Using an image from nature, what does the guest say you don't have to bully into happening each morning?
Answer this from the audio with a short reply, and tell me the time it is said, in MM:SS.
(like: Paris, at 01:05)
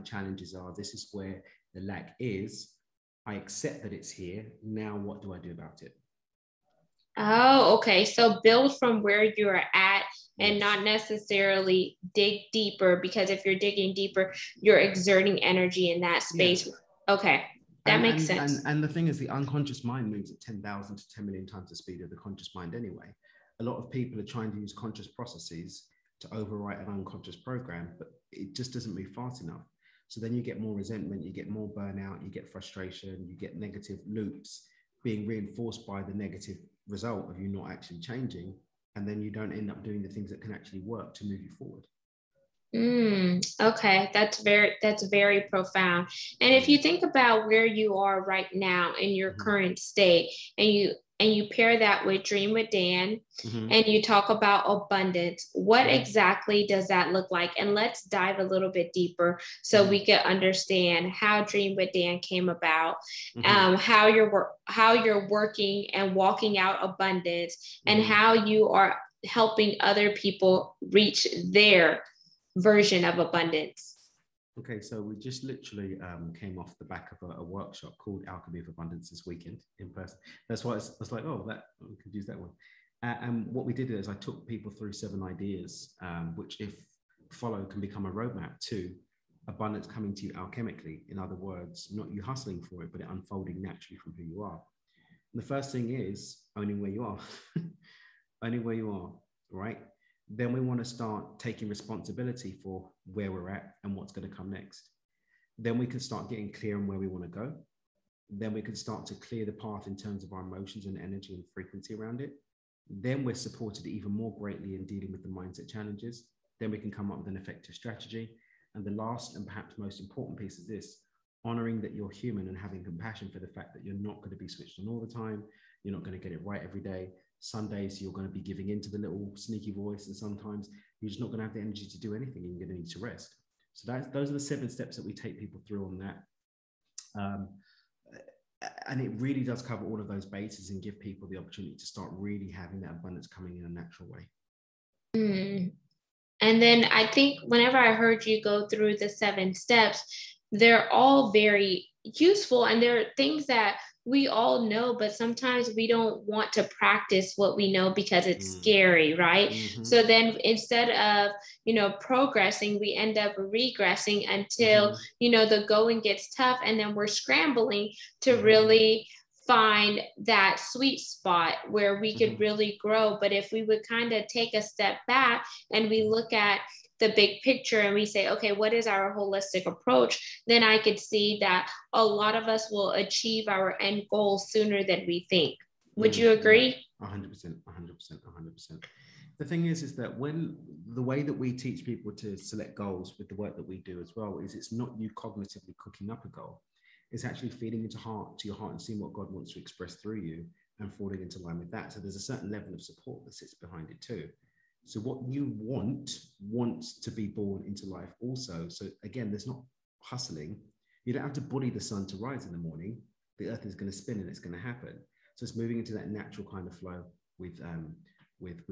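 the sun to rise, at 03:31.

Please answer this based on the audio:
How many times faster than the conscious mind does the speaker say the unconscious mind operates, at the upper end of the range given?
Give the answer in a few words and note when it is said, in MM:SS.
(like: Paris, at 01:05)
10 million, at 00:21.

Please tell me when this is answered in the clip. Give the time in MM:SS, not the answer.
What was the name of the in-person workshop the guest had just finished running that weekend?
01:18.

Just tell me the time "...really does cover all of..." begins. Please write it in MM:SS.
02:19.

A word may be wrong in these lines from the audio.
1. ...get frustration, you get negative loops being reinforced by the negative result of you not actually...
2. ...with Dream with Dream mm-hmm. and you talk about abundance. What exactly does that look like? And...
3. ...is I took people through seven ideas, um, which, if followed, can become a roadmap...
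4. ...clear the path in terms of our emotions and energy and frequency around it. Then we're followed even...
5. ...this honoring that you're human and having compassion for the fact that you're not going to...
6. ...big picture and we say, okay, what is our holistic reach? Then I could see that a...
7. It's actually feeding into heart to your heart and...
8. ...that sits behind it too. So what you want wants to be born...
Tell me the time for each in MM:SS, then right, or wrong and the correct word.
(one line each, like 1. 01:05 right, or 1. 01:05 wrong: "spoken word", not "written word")
1. 00:32 right
2. 00:52 wrong: "Dan", not "Dream"
3. 01:23 right
4. 01:49 wrong: "supported", not "followed"
5. 02:00 right
6. 02:57 wrong: "approach", not "reach"
7. 03:17 right
8. 03:23 right.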